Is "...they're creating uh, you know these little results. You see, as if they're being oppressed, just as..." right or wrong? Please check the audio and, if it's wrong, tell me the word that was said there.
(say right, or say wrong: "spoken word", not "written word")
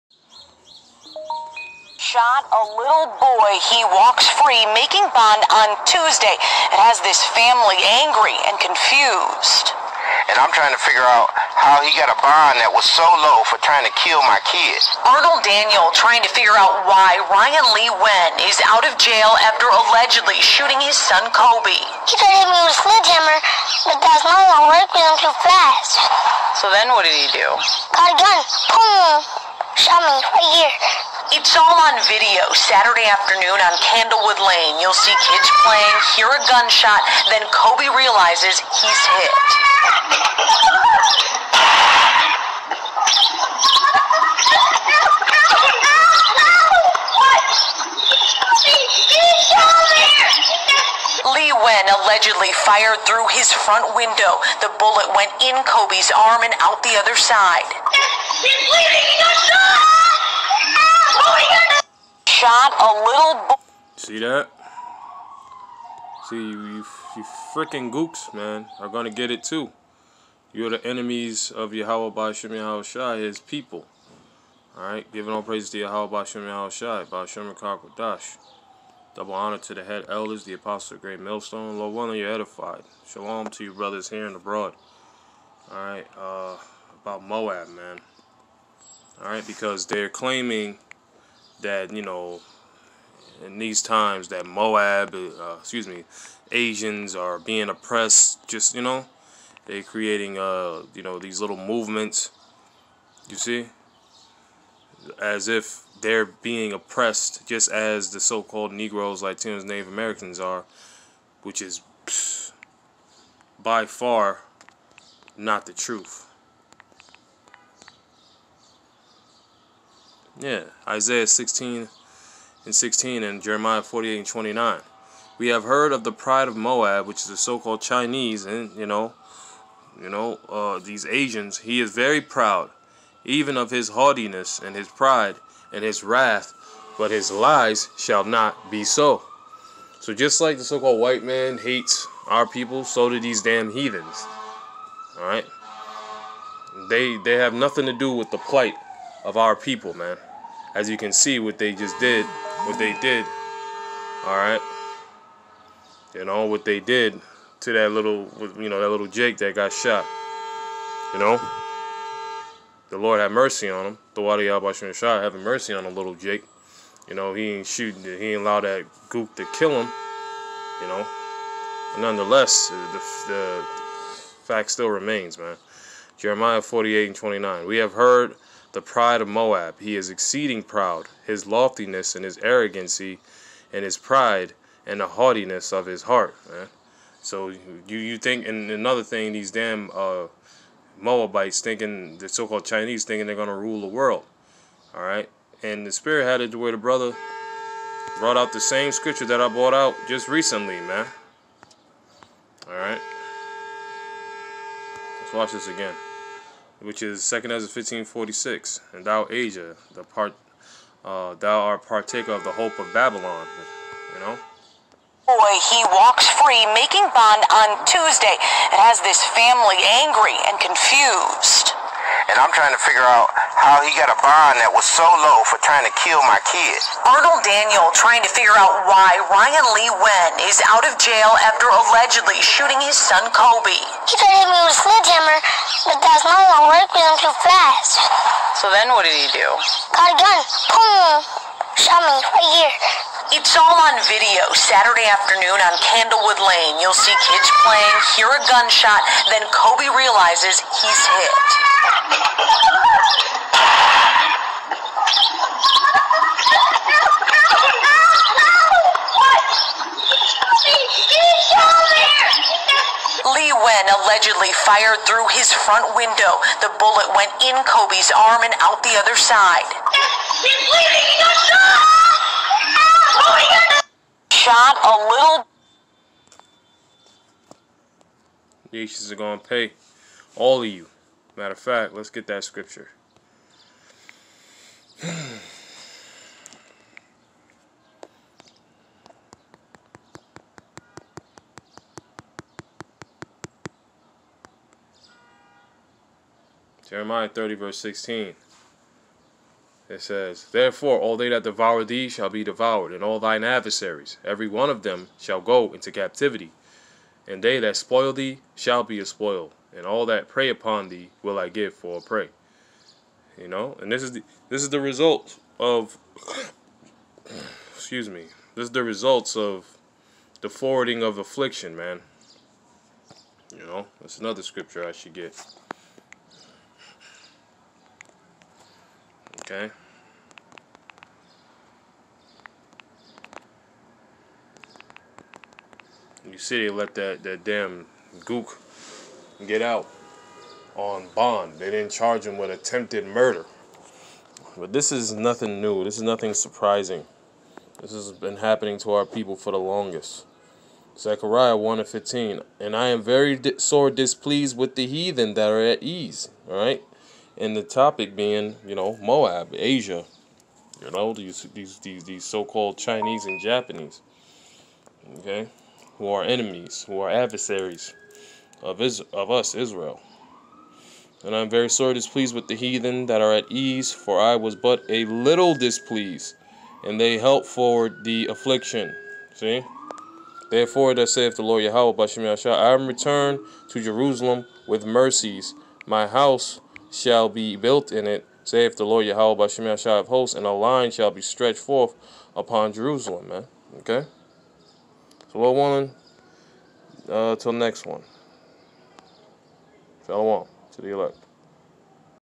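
wrong: "movements", not "results".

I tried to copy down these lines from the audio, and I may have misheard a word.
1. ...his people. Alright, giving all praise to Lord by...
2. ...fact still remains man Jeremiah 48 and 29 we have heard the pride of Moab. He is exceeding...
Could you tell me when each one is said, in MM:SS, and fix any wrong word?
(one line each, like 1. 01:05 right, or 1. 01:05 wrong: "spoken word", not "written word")
1. 01:13 wrong: "Yahweh", not "Lord"
2. 02:54 right.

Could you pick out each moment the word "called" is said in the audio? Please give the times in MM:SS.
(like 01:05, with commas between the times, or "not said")
01:48, 02:07, 02:20, 03:12, 06:02.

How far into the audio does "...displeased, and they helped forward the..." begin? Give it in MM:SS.
06:15.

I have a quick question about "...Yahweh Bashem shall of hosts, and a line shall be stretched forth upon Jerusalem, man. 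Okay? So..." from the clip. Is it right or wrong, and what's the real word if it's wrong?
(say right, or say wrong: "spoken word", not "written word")
right.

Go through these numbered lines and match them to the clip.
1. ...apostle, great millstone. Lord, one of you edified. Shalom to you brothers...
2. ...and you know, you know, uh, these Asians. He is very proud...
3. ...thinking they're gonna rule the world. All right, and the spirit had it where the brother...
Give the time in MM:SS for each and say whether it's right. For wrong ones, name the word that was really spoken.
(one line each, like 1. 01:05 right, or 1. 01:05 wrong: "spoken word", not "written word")
1. 01:20 right
2. 02:08 right
3. 03:13 right.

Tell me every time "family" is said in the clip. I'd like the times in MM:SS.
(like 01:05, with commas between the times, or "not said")
00:07, 03:39.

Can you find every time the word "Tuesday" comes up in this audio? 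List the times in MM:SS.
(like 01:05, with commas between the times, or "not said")
00:05, 03:37.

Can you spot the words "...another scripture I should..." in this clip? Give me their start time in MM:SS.
05:24.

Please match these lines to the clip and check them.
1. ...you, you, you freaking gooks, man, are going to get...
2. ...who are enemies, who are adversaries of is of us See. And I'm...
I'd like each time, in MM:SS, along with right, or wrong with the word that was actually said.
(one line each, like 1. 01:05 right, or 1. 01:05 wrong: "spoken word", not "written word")
1. 01:06 right
2. 06:05 wrong: "Israel", not "See".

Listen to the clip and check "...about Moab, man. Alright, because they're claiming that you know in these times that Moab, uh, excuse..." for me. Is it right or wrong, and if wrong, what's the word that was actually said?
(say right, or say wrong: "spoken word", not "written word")
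right.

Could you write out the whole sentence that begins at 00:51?
Lee Wen allegedly fired through his front window.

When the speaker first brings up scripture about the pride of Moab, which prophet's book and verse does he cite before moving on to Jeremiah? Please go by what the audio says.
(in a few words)
Isaiah 16:16.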